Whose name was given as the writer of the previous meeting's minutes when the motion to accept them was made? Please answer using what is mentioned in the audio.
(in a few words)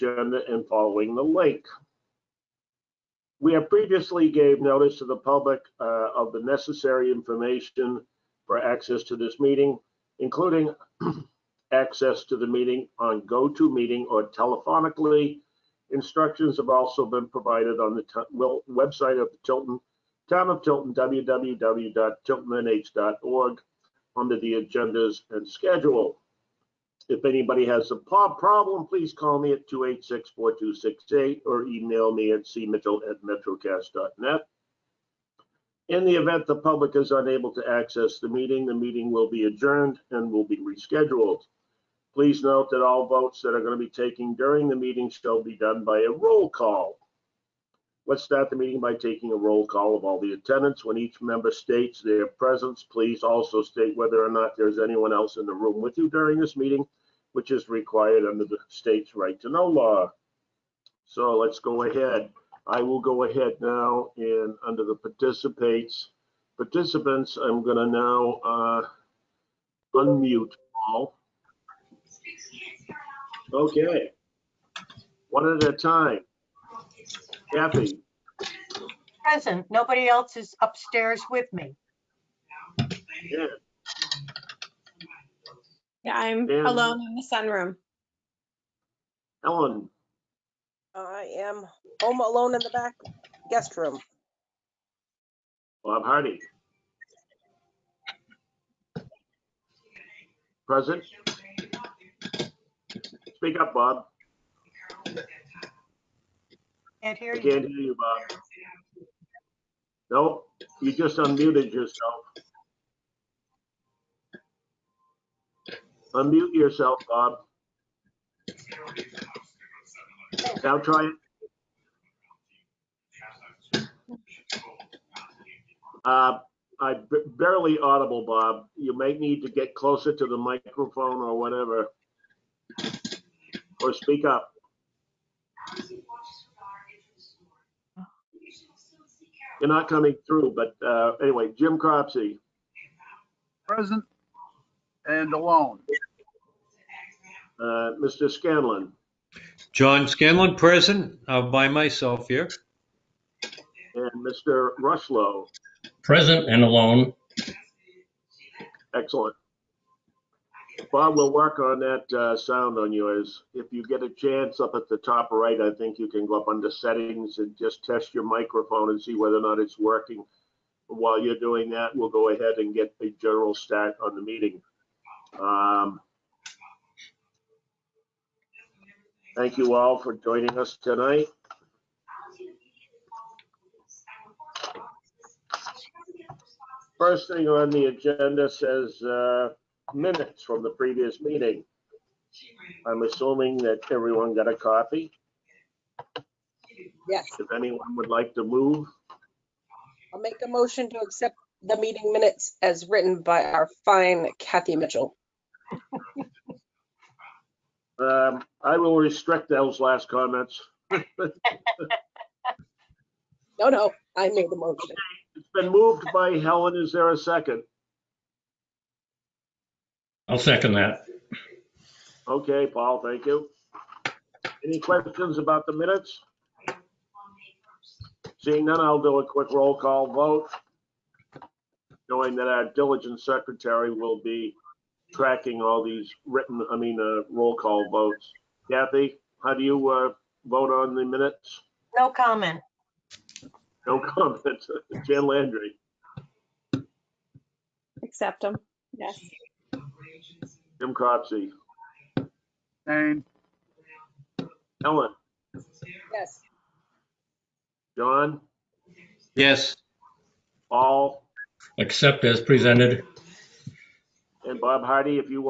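Kathy Mitchell.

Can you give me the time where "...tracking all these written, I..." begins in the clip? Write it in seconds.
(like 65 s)
235 s.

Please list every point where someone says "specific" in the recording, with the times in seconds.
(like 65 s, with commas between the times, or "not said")
not said.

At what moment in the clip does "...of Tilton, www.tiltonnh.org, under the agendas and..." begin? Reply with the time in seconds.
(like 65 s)
20 s.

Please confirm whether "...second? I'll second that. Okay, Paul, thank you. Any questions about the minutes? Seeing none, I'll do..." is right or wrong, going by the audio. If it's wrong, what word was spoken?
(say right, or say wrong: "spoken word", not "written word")
right.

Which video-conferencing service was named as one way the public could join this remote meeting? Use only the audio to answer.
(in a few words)
GoToMeeting.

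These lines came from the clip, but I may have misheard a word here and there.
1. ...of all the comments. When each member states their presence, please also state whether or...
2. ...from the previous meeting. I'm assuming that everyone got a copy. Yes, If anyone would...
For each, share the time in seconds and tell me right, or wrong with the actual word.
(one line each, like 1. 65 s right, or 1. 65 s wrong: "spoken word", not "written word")
1. 49 s wrong: "attendants", not "comments"
2. 190 s right.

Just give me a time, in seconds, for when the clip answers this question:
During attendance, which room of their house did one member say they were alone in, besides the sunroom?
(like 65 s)
92 s.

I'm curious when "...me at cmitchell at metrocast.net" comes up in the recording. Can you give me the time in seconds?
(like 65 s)
32 s.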